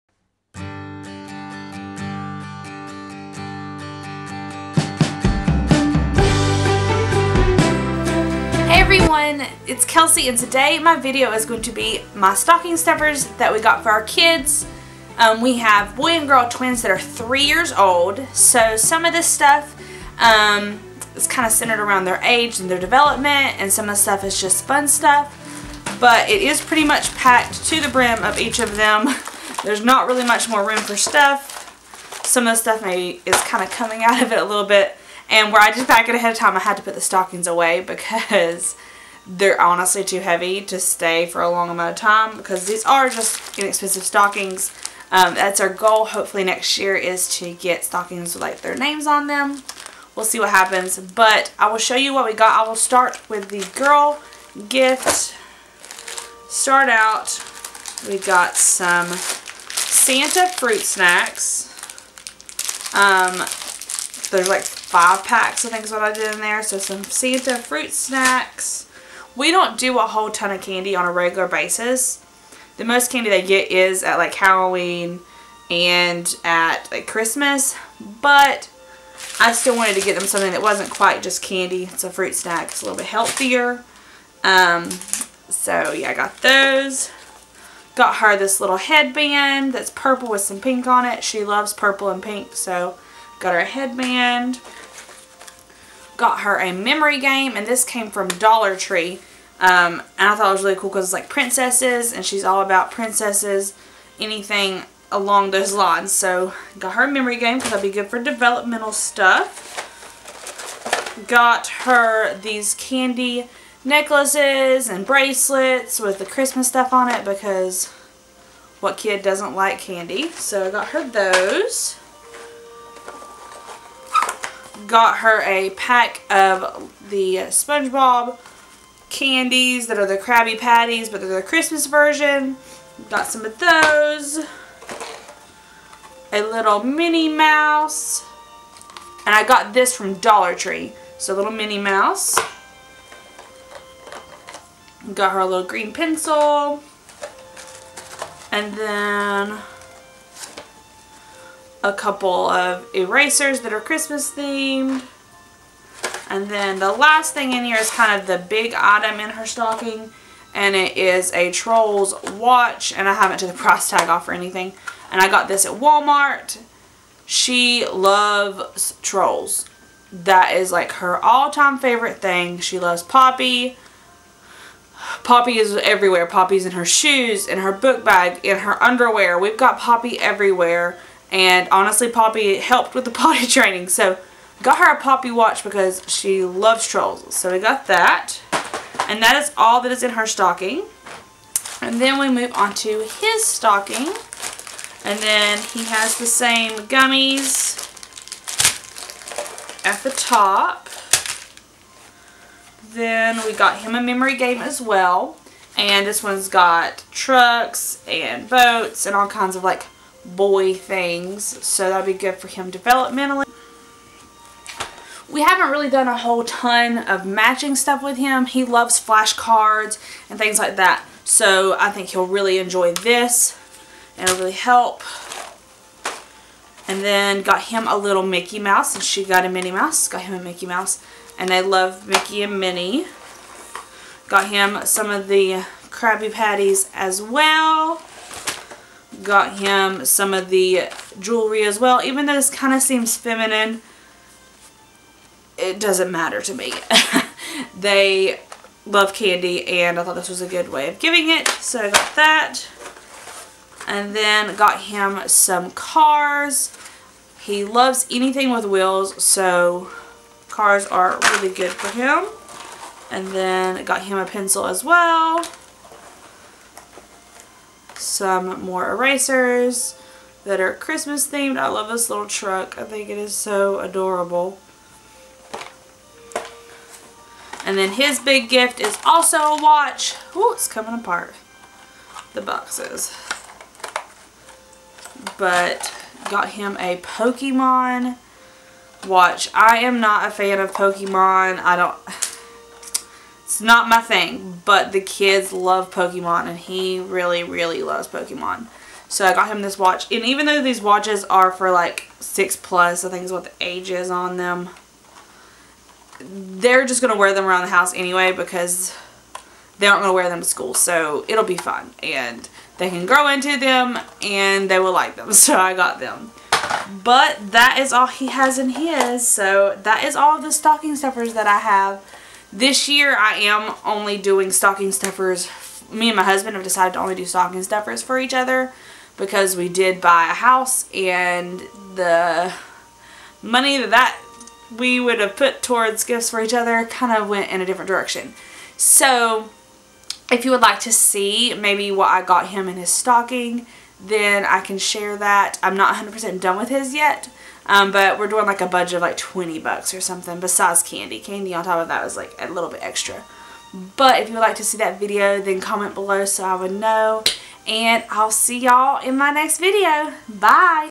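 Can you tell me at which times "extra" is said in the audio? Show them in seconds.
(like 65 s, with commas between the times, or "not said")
352 s.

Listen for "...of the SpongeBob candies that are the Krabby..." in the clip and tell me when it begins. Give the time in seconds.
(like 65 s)
126 s.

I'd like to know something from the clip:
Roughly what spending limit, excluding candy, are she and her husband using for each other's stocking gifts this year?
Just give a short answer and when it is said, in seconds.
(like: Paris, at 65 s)
$20, at 349 s.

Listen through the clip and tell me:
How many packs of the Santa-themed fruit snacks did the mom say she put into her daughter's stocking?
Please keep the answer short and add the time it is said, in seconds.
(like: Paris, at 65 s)
5, at 64 s.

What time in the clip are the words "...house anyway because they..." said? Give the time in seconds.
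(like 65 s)
307 s.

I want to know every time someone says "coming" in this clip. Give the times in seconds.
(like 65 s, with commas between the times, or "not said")
33 s, 280 s.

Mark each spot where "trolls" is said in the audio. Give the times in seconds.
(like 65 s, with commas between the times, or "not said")
161 s, 169 s, 186 s.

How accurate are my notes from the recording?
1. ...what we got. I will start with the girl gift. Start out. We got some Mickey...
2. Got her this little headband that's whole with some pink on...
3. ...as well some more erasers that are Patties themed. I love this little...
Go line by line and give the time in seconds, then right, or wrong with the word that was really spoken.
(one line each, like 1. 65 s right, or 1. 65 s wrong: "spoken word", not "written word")
1. 52 s wrong: "Santa", not "Mickey"
2. 87 s wrong: "purple", not "whole"
3. 264 s wrong: "Christmas", not "Patties".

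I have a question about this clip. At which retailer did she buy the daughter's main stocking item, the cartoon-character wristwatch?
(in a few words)
Walmart.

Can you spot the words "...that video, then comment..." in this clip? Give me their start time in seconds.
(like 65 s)
354 s.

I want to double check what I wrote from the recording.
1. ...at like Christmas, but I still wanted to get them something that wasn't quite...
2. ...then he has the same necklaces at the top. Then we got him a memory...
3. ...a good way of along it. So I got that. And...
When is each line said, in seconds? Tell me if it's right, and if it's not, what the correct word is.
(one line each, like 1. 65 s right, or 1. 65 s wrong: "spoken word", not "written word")
1. 76 s right
2. 195 s wrong: "gummies", not "necklaces"
3. 250 s wrong: "giving", not "along".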